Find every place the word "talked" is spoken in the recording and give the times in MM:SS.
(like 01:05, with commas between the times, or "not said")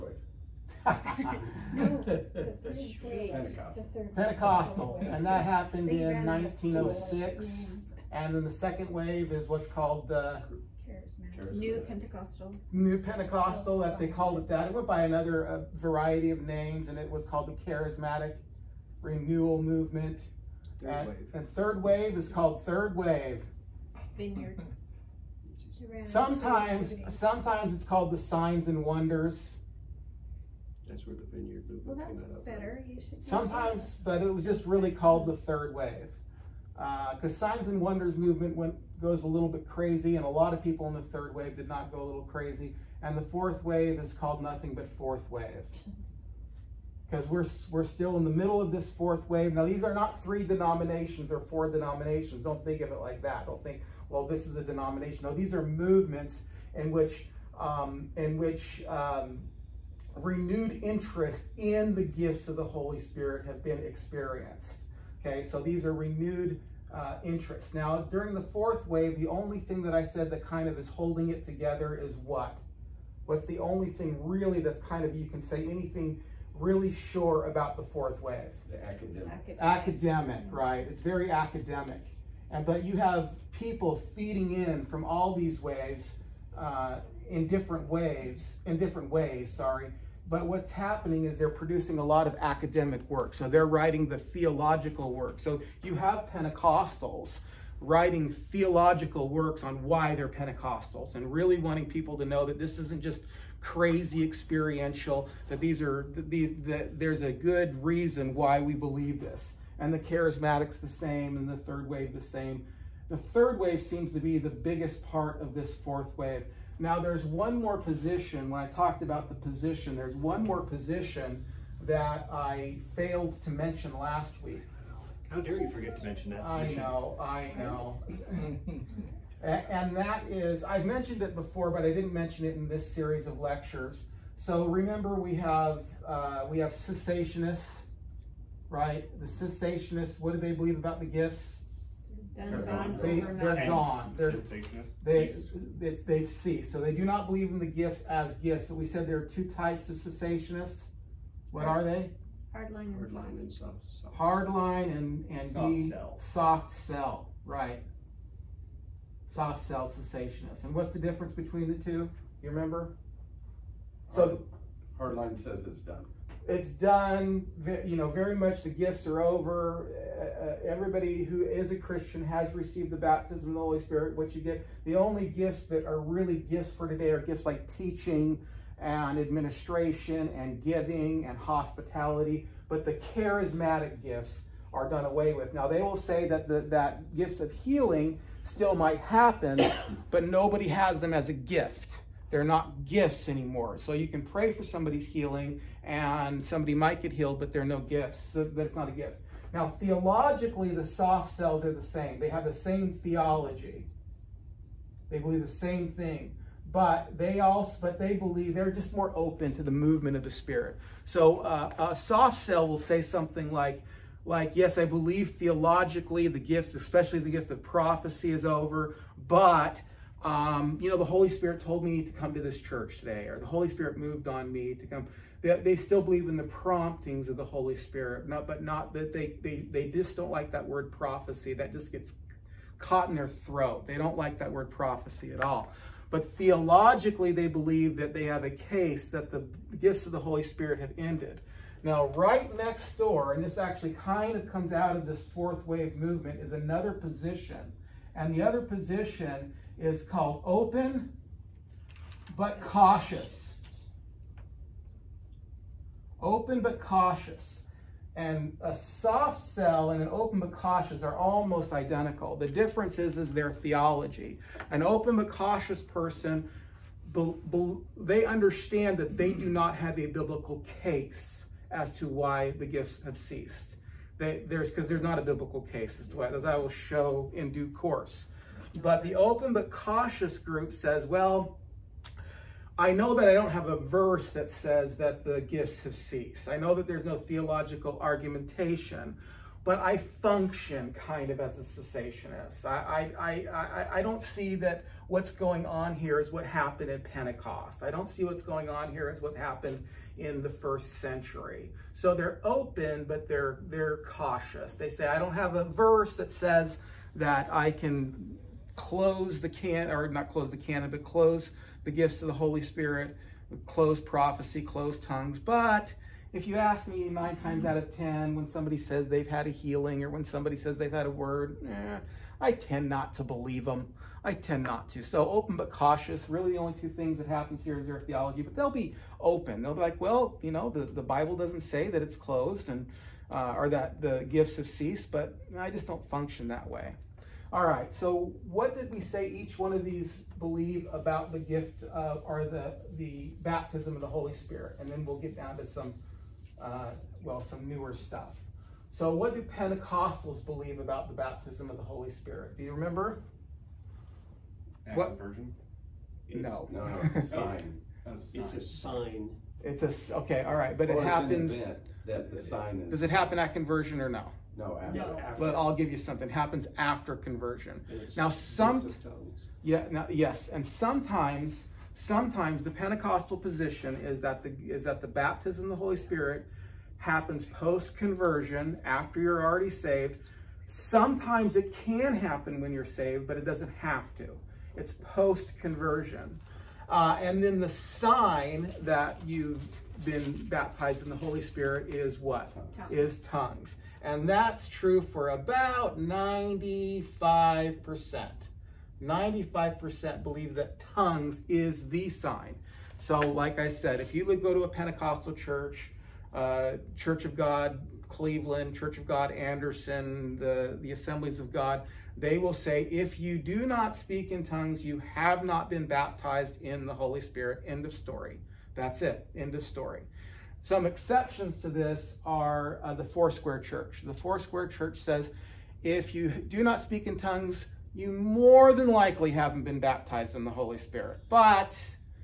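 01:58.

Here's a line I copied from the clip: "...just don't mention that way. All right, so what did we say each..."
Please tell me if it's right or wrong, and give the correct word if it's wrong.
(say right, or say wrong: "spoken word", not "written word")
wrong: "function", not "mention".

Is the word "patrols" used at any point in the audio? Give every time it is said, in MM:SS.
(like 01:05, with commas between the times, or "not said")
not said.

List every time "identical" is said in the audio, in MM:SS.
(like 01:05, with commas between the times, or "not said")
04:21.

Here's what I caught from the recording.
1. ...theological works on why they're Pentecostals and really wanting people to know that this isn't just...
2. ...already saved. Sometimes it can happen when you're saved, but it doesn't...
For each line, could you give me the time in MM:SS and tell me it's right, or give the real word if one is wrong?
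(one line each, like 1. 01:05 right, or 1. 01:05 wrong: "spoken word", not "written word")
1. 01:38 right
2. 06:19 right.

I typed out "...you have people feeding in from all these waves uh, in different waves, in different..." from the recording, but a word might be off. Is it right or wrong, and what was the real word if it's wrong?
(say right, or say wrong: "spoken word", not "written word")
right.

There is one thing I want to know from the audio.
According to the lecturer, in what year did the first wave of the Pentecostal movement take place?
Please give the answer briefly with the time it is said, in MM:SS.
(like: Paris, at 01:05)
1906, at 00:06.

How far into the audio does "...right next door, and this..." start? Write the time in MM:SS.
04:02.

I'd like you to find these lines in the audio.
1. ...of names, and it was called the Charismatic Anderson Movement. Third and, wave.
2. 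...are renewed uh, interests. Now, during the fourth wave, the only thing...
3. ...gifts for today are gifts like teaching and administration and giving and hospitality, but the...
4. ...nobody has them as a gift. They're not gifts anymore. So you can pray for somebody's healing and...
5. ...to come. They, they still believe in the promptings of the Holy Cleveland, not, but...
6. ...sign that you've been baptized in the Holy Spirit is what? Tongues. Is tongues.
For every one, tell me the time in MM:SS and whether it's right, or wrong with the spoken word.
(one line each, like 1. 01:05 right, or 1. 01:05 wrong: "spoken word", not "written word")
1. 00:16 wrong: "Renewal", not "Anderson"
2. 01:05 right
3. 02:56 right
4. 03:10 right
5. 03:44 wrong: "Spirit", not "Cleveland"
6. 06:27 right.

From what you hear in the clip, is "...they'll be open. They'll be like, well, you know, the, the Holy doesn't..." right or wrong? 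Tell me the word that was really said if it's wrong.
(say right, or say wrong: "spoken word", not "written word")
wrong: "Bible", not "Holy".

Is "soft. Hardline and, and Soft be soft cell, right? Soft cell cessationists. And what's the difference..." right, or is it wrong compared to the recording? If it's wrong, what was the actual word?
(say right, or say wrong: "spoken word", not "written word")
right.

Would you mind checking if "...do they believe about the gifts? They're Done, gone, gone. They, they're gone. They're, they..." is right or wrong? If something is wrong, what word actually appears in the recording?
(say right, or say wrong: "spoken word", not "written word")
right.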